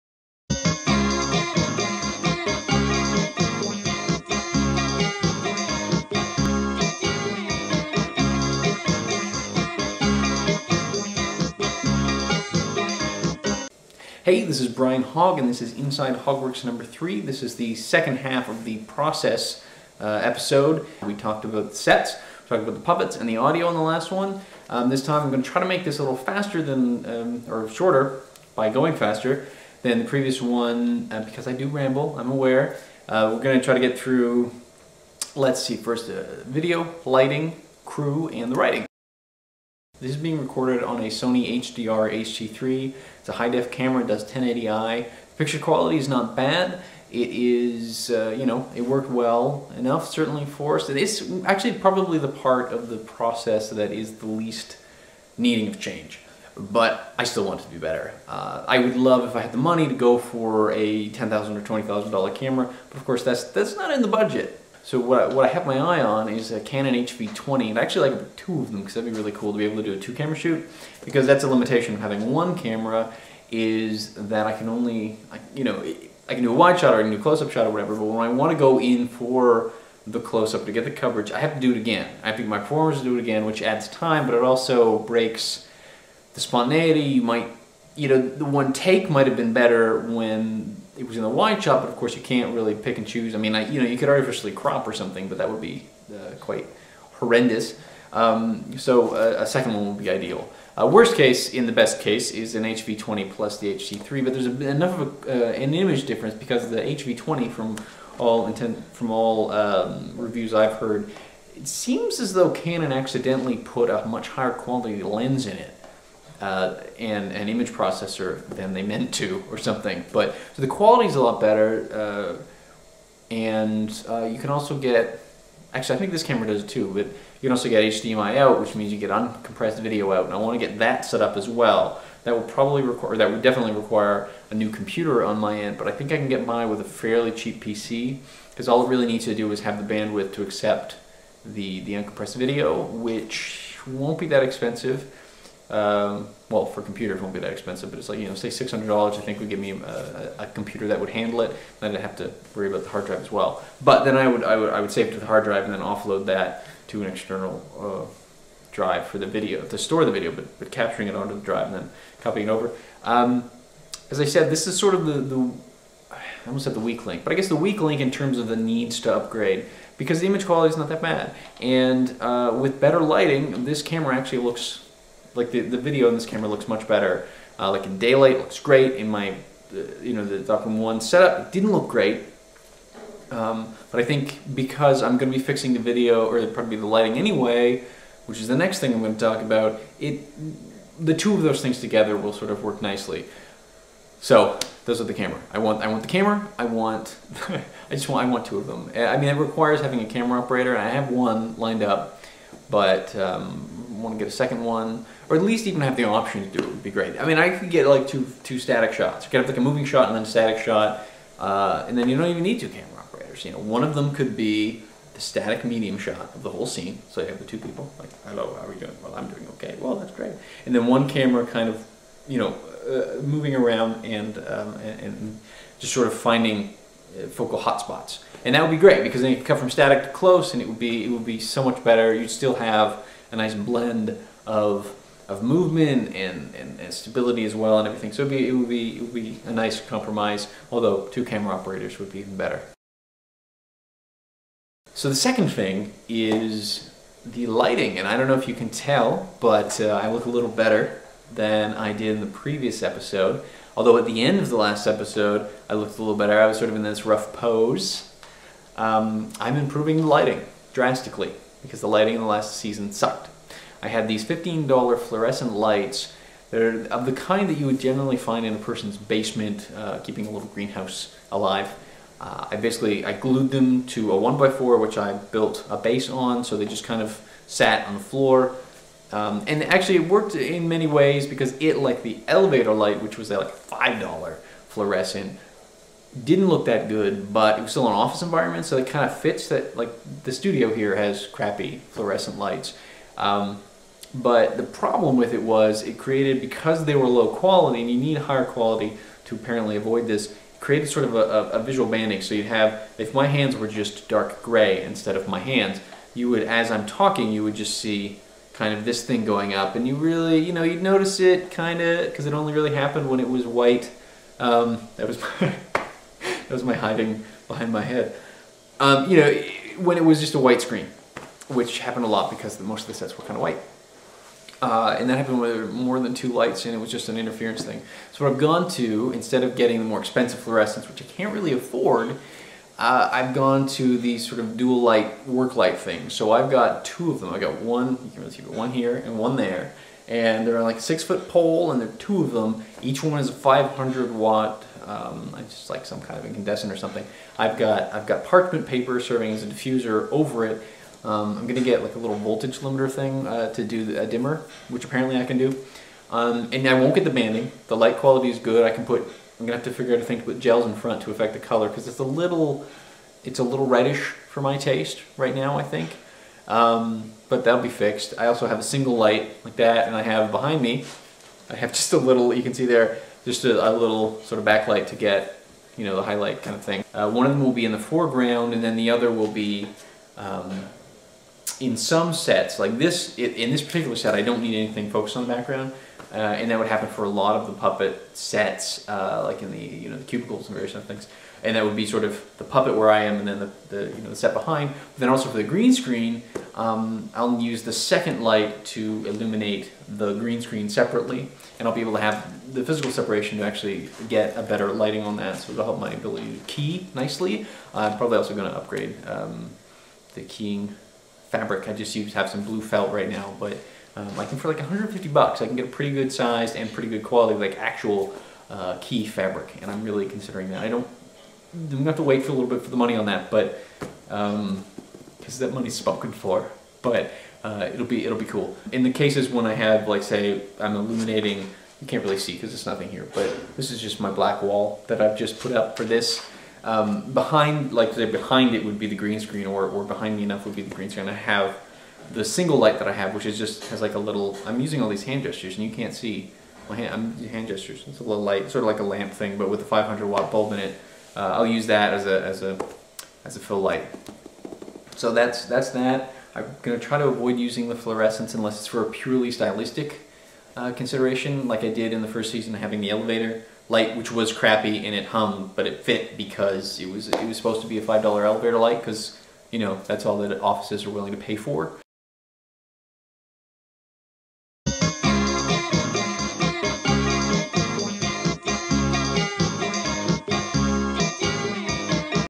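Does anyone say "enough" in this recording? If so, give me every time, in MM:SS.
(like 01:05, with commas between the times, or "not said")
00:49, 01:44, 07:20.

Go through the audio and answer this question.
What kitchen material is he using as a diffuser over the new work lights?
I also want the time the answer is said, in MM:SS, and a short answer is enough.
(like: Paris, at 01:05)
parchment paper, at 05:48.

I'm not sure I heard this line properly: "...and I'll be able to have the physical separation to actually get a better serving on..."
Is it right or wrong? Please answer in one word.
wrong.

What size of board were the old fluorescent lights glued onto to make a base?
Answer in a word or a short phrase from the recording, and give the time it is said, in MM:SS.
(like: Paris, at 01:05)
1x4, at 04:34.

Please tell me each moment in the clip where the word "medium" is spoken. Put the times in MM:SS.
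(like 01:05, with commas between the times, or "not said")
03:35.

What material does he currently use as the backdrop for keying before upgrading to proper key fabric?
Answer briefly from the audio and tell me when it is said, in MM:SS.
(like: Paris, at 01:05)
blue felt, at 06:52.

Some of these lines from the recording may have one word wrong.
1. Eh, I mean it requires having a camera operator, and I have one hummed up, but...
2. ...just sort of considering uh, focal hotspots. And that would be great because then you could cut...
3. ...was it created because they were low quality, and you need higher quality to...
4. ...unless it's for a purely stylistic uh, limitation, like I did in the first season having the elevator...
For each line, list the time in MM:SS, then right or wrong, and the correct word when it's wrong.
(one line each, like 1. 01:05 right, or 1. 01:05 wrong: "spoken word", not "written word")
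1. 03:18 wrong: "lined", not "hummed"
2. 03:45 wrong: "finding", not "considering"
3. 04:55 right
4. 07:38 wrong: "consideration", not "limitation".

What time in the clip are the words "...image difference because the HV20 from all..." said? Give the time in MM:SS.
01:45.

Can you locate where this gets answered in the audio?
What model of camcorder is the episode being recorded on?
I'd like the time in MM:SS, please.
00:41.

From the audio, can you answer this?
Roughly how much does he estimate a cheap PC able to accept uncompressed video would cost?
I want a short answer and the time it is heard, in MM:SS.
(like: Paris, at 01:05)
$600, at 02:28.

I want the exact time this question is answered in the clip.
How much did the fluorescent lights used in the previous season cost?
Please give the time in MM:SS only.
04:24.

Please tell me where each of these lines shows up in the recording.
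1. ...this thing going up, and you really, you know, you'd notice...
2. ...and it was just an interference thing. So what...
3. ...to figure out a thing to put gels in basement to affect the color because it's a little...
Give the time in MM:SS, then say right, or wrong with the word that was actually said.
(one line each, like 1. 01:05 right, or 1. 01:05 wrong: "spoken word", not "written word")
1. 05:08 right
2. 05:26 right
3. 05:59 wrong: "front", not "basement".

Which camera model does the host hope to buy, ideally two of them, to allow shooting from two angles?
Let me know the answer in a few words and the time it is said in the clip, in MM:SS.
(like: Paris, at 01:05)
Canon HV20, at 01:06.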